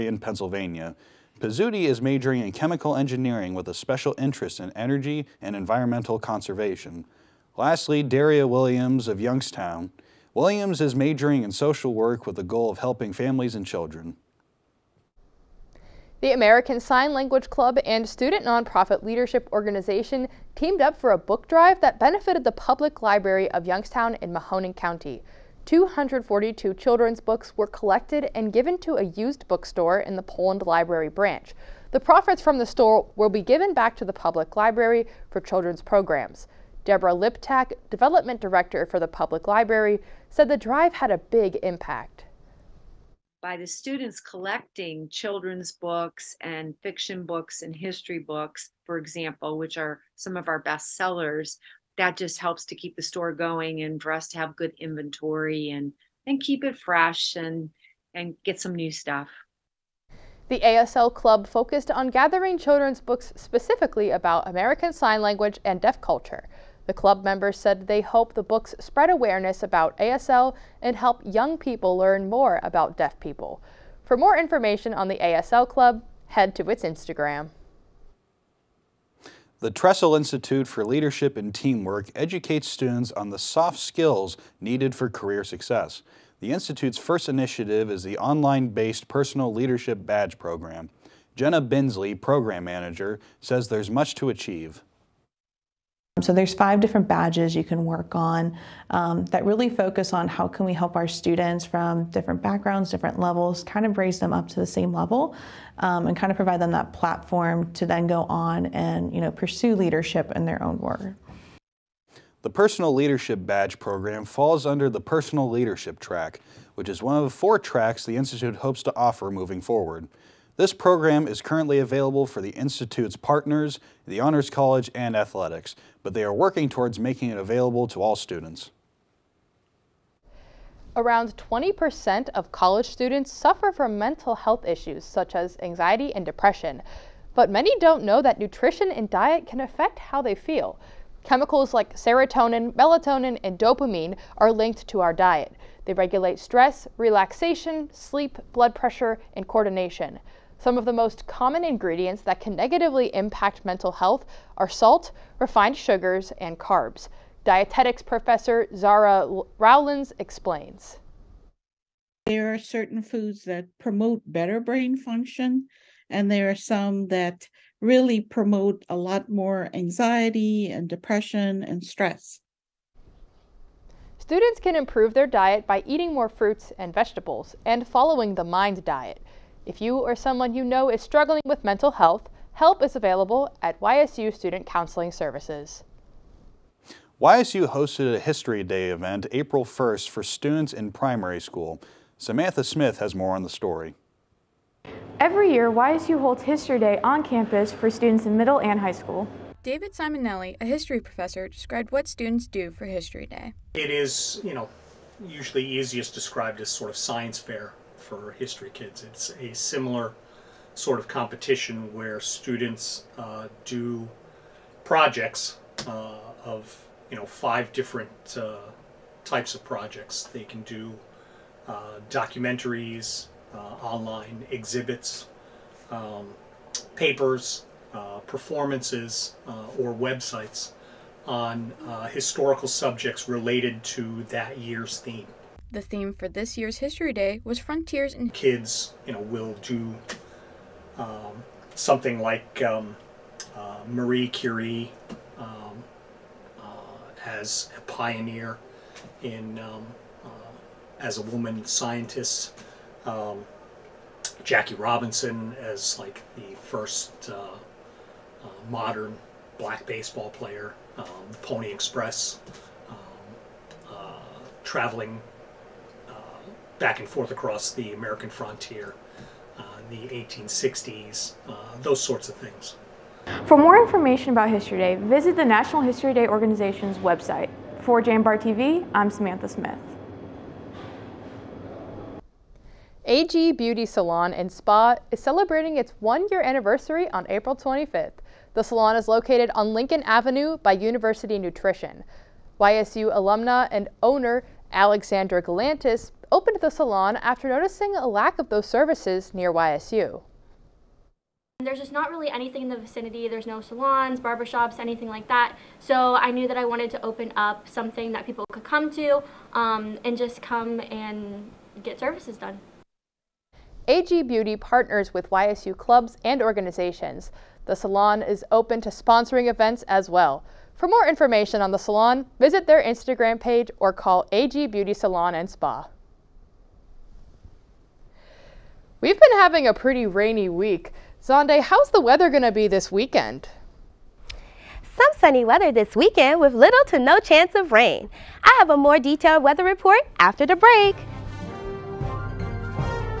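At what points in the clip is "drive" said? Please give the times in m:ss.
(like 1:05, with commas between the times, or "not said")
0:21, 0:40.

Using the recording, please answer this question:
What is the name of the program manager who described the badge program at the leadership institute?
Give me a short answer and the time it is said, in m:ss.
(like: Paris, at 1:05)
Jenna Binsley, at 1:31.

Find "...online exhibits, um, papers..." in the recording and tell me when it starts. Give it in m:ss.
3:43.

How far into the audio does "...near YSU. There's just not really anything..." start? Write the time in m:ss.
4:59.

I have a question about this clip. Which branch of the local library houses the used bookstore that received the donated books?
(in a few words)
Poland Library.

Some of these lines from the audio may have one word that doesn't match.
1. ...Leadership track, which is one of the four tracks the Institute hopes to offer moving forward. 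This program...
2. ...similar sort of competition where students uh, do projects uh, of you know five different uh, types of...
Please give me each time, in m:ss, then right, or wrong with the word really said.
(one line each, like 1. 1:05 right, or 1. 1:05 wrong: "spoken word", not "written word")
1. 1:55 right
2. 3:29 right.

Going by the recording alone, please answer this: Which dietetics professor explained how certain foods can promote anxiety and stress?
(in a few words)
Zara Rowlands.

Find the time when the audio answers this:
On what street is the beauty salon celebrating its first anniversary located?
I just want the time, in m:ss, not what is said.
4:49.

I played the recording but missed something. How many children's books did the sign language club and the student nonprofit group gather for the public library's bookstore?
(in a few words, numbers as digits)
242.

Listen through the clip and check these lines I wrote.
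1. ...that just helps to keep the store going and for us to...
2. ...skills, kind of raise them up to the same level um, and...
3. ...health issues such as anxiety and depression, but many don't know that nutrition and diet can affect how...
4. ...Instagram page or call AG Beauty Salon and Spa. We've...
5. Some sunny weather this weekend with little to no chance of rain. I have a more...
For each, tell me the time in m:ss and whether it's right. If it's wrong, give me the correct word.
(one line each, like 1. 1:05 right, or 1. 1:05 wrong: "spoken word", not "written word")
1. 0:51 right
2. 1:43 wrong: "levels", not "skills"
3. 2:14 right
4. 5:22 right
5. 5:34 right.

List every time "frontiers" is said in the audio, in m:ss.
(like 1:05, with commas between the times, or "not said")
3:57, 4:28.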